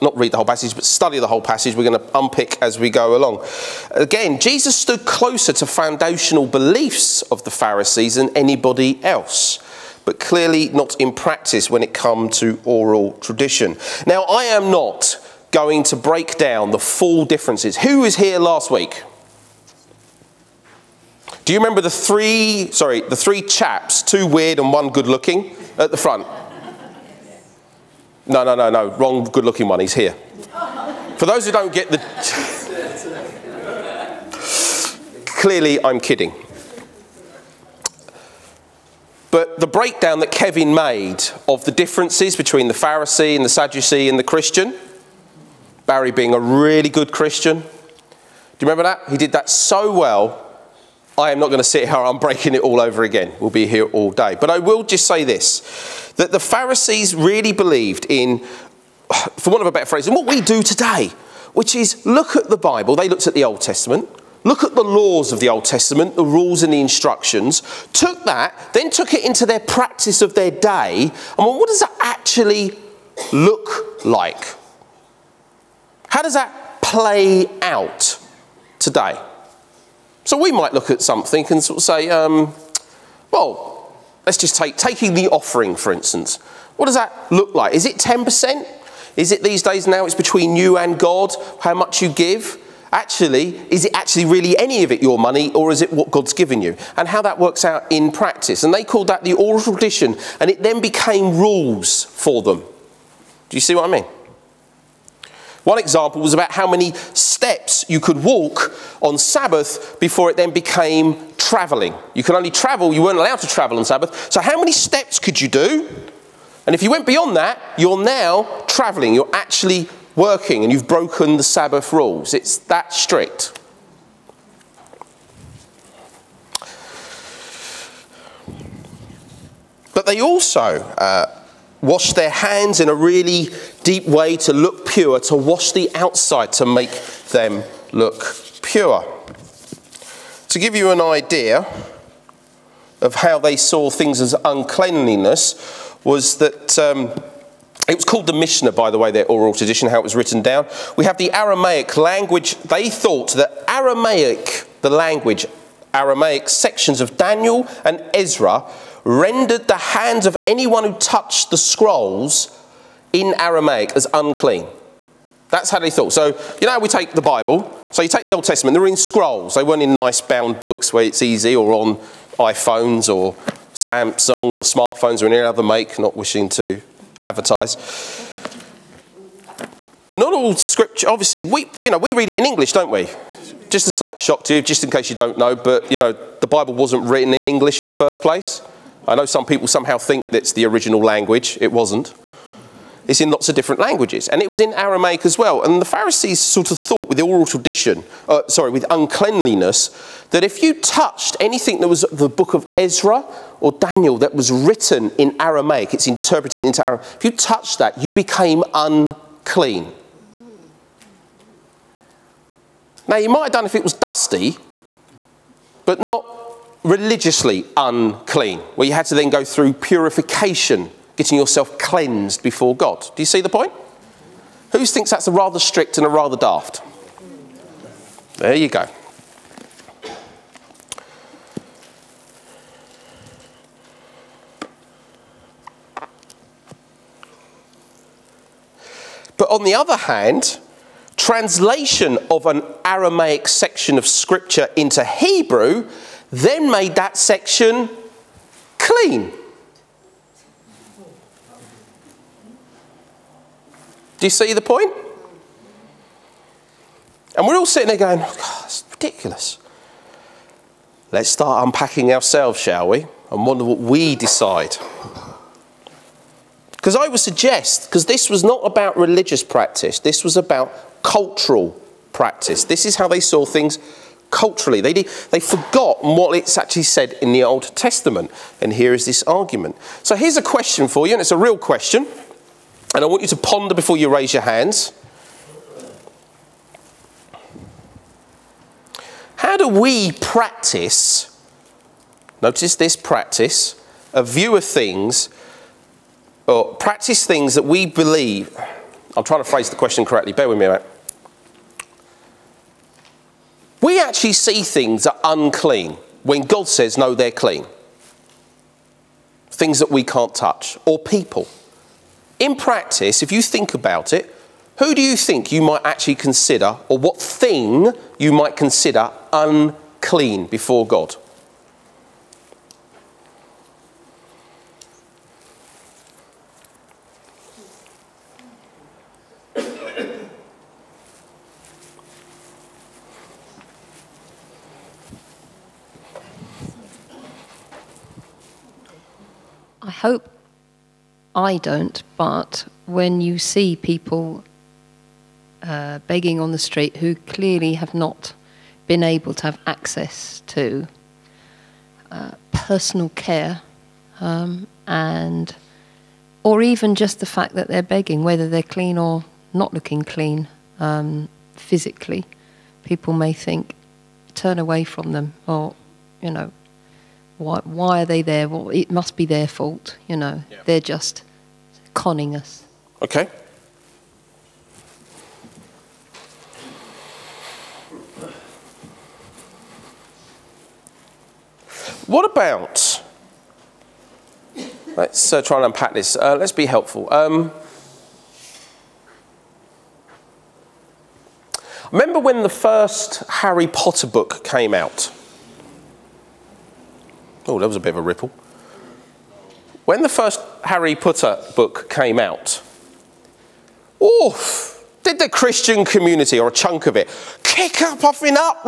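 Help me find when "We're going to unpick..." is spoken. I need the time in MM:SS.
00:01.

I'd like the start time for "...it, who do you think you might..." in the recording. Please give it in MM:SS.
05:14.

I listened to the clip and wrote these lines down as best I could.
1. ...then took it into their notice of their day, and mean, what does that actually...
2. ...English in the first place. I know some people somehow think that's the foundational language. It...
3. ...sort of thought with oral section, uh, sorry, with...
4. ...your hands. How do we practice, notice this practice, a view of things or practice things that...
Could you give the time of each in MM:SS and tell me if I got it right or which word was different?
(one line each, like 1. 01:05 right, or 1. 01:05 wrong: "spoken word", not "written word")
1. 01:08 wrong: "practice", not "notice"
2. 03:07 wrong: "original", not "foundational"
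3. 03:16 wrong: "tradition", not "section"
4. 04:44 right.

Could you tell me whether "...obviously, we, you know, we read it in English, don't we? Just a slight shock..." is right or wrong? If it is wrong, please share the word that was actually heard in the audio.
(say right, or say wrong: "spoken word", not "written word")
right.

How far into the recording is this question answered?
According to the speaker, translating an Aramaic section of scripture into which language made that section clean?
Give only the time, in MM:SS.
04:05.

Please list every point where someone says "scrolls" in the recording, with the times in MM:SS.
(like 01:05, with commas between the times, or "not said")
02:41, 02:48.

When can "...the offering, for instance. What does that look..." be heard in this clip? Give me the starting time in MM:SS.
01:25.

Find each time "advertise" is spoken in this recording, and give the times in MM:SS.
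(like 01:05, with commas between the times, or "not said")
02:57.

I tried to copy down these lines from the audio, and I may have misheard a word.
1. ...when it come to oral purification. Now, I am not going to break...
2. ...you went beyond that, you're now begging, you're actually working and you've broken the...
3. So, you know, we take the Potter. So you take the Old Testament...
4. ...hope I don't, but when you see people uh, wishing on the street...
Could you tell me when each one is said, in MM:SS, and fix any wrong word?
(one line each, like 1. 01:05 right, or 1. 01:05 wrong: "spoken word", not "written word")
1. 00:11 wrong: "tradition", not "purification"
2. 01:56 wrong: "traveling", not "begging"
3. 02:46 wrong: "Bible", not "Potter"
4. 05:39 wrong: "begging", not "wishing".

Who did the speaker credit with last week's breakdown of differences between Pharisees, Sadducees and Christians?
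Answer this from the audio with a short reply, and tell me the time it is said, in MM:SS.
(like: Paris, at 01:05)
Kevin, at 00:40.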